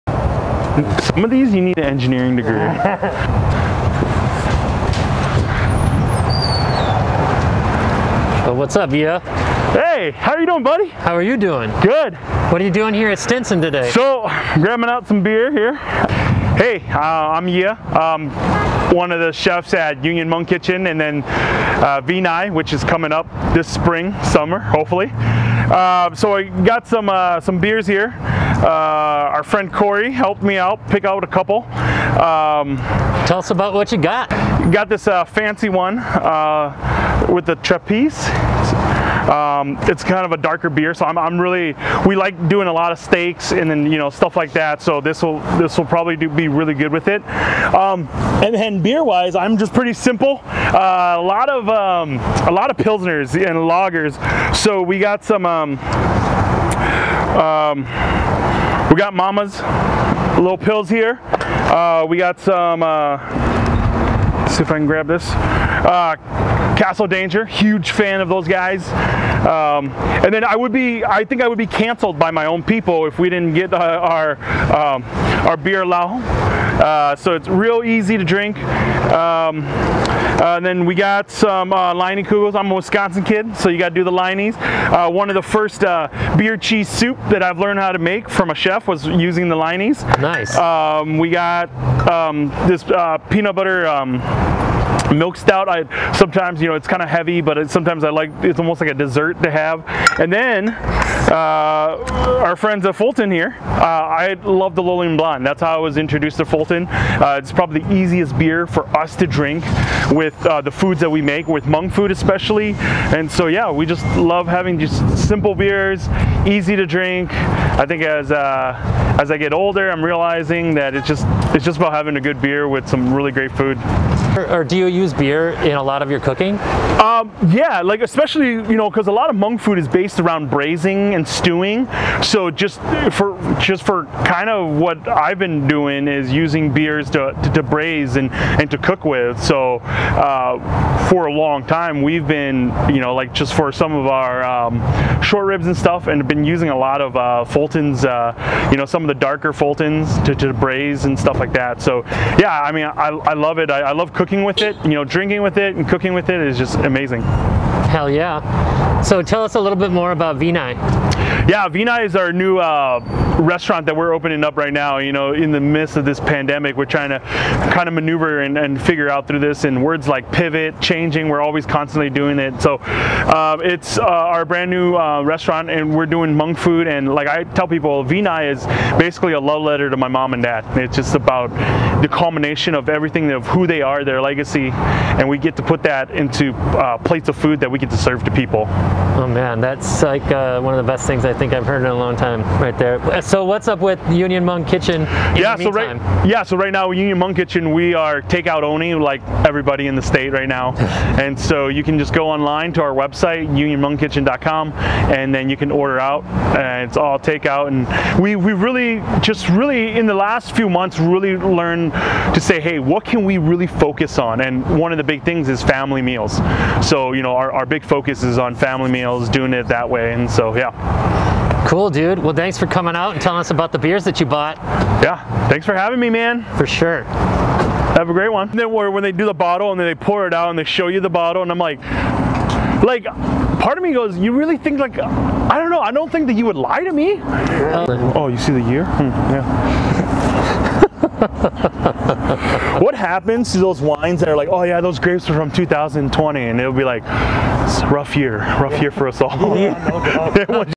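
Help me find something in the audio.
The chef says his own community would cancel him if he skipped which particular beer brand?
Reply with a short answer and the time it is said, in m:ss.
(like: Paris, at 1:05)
Beerlao, at 1:15.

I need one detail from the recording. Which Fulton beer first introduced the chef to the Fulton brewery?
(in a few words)
Lonely Blonde.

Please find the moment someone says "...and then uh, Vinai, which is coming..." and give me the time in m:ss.
0:20.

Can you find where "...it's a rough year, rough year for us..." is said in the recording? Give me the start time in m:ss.
4:07.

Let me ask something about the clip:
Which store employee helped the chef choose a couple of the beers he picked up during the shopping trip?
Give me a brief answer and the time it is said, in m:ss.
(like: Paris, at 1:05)
Corey, at 0:29.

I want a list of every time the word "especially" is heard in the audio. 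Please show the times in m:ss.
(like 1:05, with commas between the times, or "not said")
1:52, 2:08.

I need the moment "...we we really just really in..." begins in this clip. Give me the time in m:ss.
3:28.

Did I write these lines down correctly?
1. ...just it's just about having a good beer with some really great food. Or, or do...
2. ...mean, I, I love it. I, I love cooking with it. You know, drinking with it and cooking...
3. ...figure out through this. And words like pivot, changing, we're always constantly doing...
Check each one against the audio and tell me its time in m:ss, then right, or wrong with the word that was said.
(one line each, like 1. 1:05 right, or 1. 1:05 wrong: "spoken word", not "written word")
1. 2:01 right
2. 2:32 right
3. 2:48 right.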